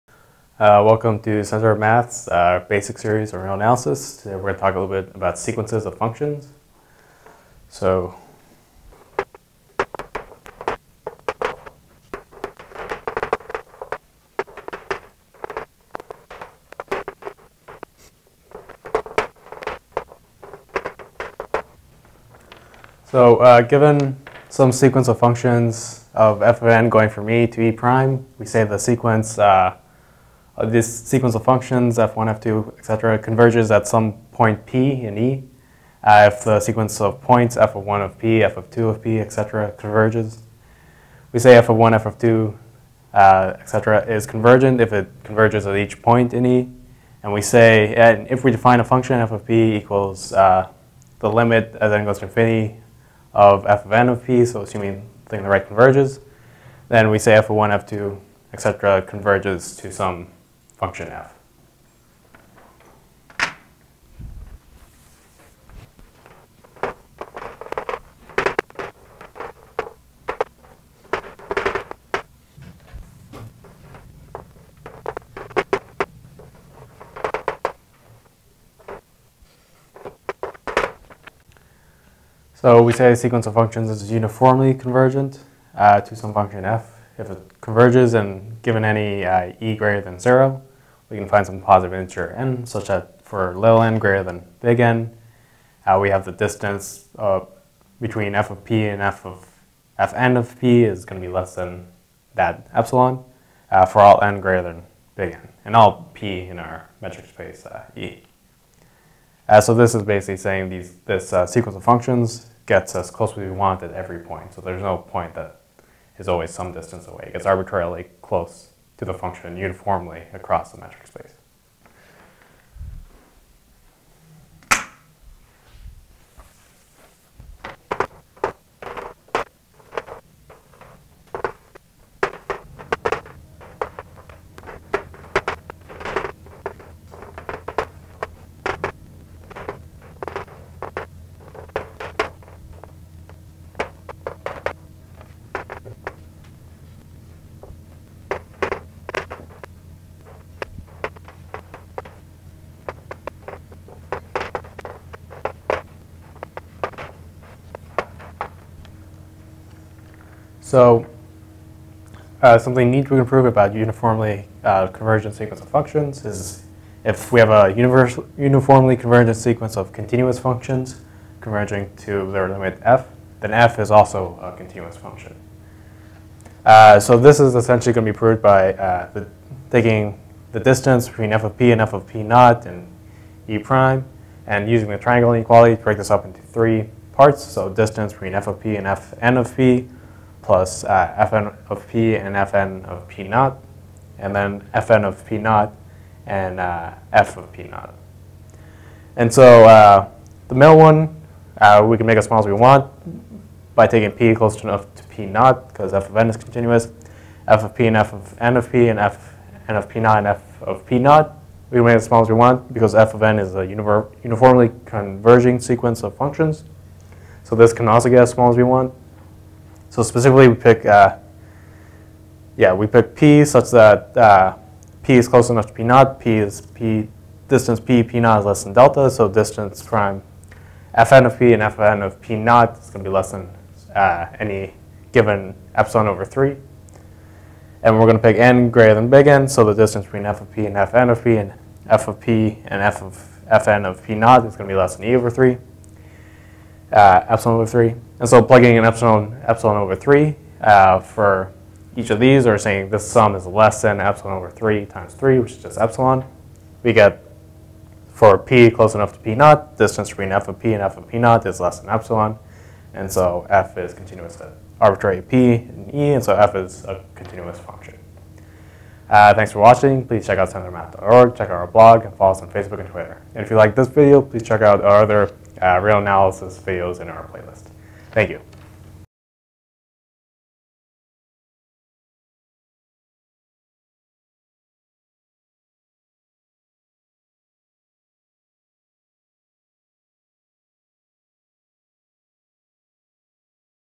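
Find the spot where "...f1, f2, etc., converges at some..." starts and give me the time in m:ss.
0:31.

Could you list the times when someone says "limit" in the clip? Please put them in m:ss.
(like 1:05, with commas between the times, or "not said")
0:51, 2:52.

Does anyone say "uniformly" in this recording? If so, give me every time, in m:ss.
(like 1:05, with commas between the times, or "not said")
1:24, 1:59, 2:43, 2:48, 3:33.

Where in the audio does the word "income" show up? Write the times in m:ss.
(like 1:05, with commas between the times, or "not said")
not said.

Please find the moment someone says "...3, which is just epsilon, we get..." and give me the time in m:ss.
4:15.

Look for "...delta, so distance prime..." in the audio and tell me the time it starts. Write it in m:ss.
3:48.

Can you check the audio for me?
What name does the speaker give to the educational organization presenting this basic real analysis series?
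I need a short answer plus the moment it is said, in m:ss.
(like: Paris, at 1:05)
Center of Math, at 0:01.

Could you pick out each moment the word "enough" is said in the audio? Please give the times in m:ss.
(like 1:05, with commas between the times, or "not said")
3:24, 3:45, 4:18.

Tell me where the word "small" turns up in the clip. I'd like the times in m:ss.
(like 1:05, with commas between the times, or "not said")
3:22, 3:32, 3:38.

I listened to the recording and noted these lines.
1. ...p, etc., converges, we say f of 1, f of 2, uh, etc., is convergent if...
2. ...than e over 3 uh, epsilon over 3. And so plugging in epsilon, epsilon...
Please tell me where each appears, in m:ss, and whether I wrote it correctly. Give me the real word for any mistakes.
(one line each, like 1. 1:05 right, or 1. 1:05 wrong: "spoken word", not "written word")
1. 0:39 right
2. 4:04 right.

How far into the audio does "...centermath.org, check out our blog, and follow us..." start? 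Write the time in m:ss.
4:30.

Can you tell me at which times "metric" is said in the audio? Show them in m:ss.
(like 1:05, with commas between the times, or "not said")
1:47, 2:00.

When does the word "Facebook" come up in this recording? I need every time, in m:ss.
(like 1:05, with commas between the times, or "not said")
4:32.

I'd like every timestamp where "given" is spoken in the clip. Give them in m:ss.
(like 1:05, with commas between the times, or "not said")
0:23, 1:28, 3:55.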